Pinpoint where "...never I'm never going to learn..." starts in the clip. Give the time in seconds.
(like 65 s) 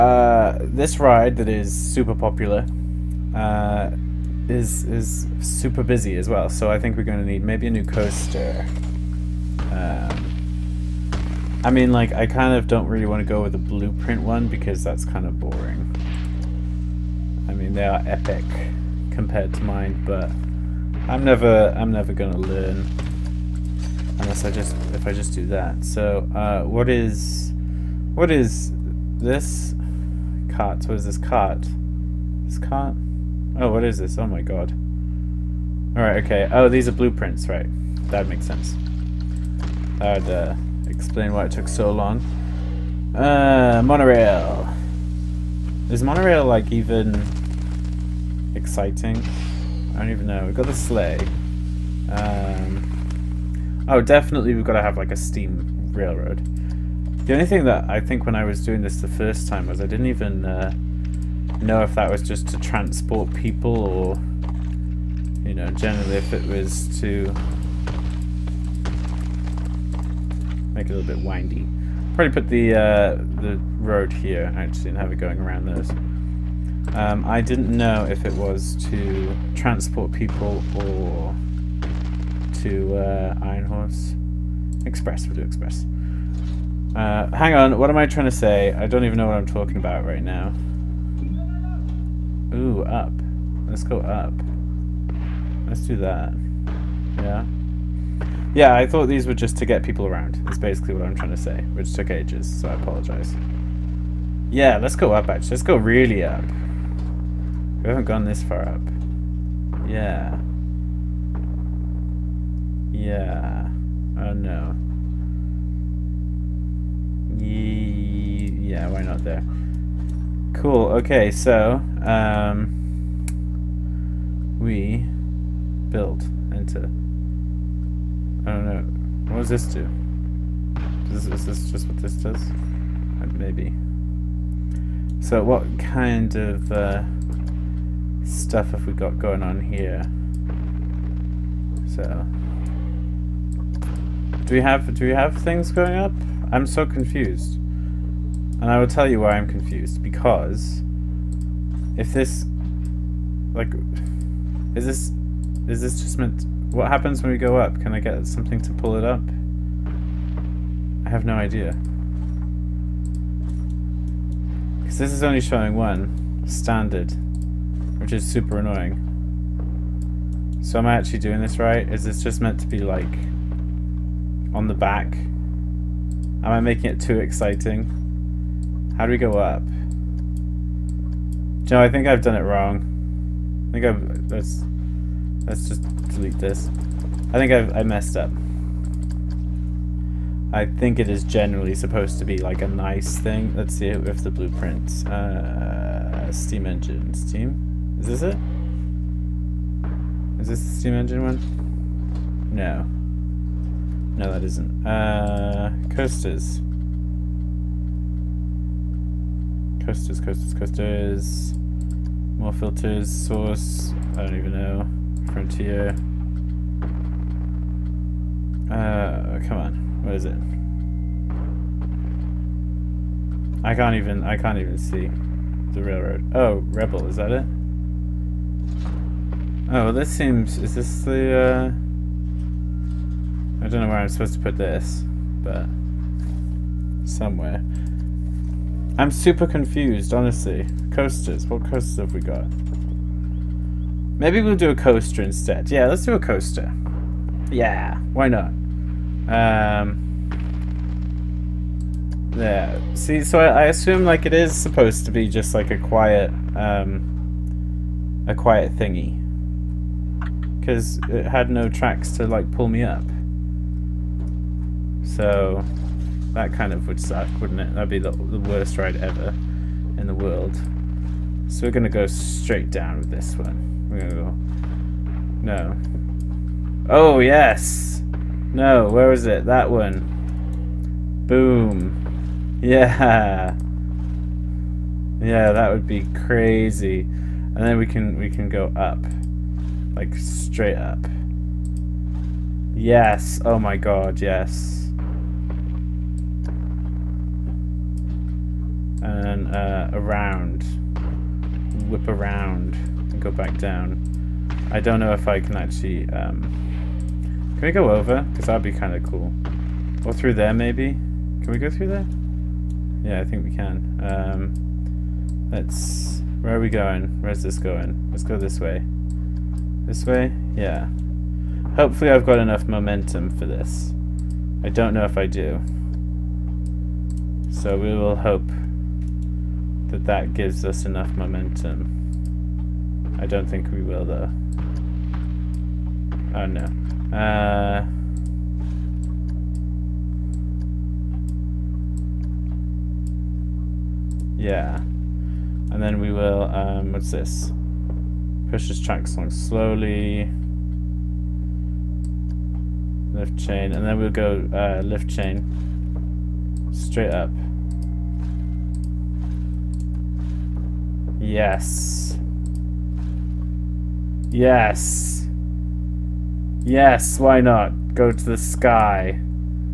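21 s.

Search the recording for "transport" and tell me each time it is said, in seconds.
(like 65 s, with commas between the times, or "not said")
62 s, 79 s.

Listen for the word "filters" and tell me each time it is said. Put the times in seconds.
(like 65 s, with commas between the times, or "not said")
212 s.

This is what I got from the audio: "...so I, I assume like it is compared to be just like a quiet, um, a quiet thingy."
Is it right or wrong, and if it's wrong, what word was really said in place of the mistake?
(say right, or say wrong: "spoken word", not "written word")
wrong: "supposed", not "compared".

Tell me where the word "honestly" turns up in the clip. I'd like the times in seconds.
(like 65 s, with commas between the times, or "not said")
240 s.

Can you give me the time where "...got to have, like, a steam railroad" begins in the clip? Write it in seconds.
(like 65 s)
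54 s.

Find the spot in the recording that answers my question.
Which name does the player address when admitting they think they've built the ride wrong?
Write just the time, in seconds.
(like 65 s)
181 s.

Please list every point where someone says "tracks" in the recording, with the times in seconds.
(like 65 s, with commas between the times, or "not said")
261 s, 348 s.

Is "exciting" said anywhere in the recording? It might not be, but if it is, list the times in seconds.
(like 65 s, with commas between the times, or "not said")
48 s, 177 s.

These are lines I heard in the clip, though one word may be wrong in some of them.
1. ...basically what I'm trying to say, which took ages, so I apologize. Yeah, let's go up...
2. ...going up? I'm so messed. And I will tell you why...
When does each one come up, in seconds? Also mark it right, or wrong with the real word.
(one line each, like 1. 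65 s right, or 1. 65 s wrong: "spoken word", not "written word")
1. 100 s right
2. 145 s wrong: "confused", not "messed".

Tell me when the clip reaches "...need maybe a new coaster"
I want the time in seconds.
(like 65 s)
7 s.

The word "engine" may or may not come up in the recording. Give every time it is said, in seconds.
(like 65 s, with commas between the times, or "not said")
196 s, 200 s.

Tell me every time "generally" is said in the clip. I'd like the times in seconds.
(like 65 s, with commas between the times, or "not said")
65 s, 191 s.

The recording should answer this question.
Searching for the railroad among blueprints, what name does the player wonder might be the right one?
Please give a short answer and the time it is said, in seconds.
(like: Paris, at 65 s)
Rebel, at 226 s.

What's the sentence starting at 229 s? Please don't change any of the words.
Oh, well, this seems, is this the, uh, I don't know where I'm supposed to put this, but somewhere.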